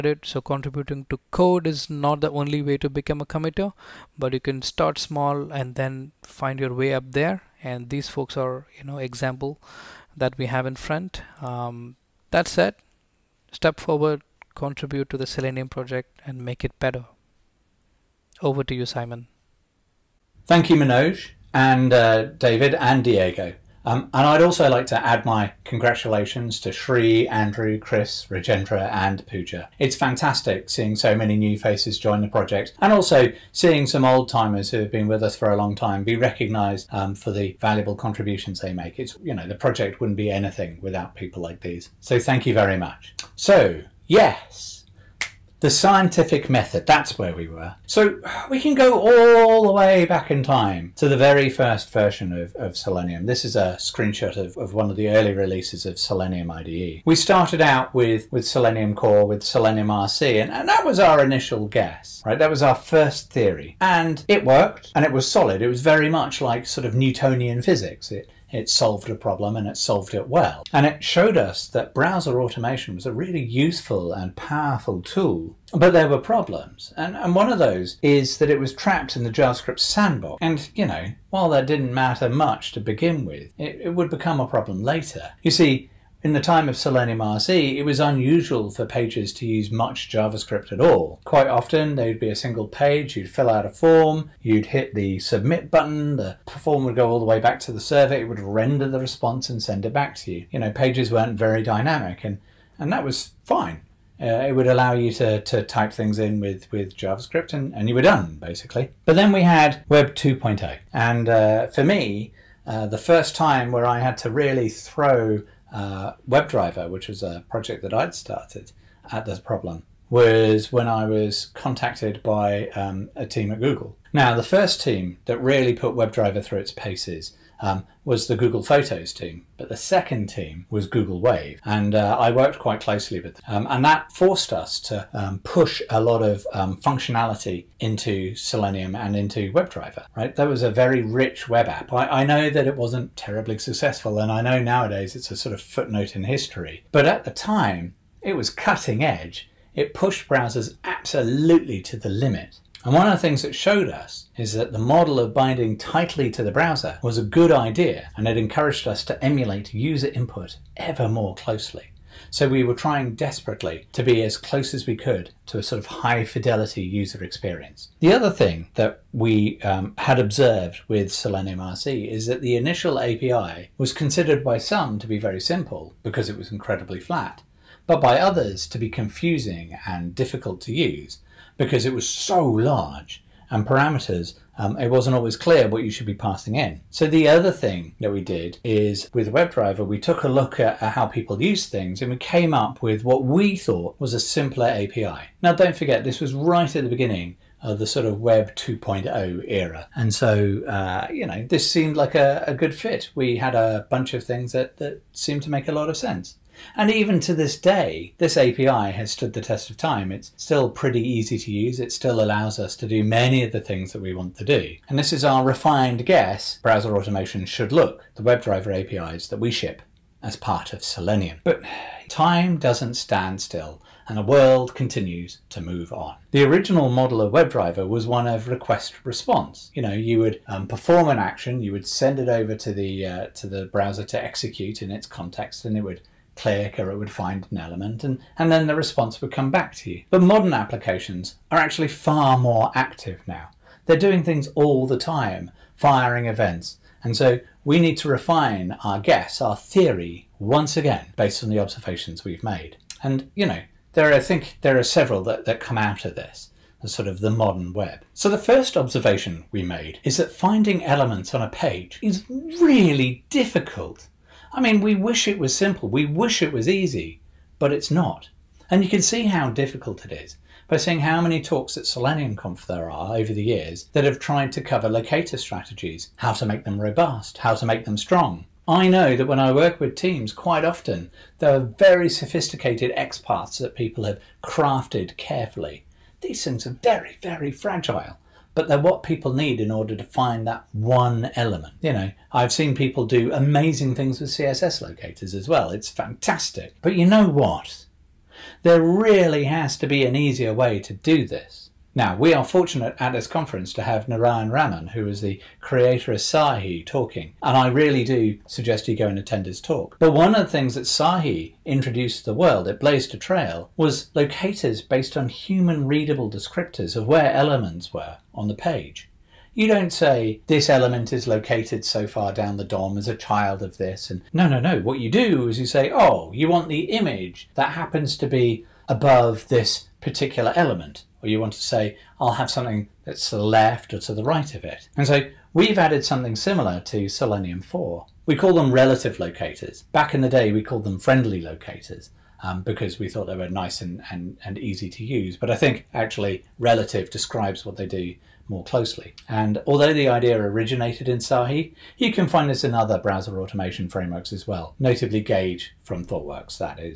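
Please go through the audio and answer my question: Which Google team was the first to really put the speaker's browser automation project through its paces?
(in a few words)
Google Photos.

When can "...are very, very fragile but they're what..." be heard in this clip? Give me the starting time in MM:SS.
04:46.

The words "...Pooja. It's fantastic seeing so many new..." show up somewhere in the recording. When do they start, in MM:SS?
00:29.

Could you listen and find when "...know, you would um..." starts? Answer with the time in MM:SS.
03:49.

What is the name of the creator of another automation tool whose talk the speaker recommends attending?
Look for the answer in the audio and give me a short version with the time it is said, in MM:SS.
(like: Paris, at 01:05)
Narayan Raman, at 05:04.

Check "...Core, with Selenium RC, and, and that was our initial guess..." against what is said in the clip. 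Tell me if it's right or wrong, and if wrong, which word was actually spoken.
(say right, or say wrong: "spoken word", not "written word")
right.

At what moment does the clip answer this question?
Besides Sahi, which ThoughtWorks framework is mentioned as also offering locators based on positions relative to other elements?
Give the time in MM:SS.
05:55.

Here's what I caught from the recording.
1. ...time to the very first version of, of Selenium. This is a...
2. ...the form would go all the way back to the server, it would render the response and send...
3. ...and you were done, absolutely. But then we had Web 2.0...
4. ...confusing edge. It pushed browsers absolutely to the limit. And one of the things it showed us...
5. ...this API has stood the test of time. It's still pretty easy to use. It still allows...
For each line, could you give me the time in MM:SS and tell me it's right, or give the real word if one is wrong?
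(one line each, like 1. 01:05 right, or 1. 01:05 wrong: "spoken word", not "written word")
1. 00:50 right
2. 01:36 right
3. 01:47 wrong: "basically", not "absolutely"
4. 02:28 wrong: "cutting", not "confusing"
5. 03:28 right.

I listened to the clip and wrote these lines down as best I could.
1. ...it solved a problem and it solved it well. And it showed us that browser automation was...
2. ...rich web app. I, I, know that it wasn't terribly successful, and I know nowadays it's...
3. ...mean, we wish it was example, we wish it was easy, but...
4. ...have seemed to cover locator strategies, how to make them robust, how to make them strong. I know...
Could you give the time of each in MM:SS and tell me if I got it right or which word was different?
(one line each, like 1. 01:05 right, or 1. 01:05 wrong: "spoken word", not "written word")
1. 01:08 right
2. 02:21 right
3. 04:24 wrong: "simple", not "example"
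4. 04:34 wrong: "tried", not "seemed".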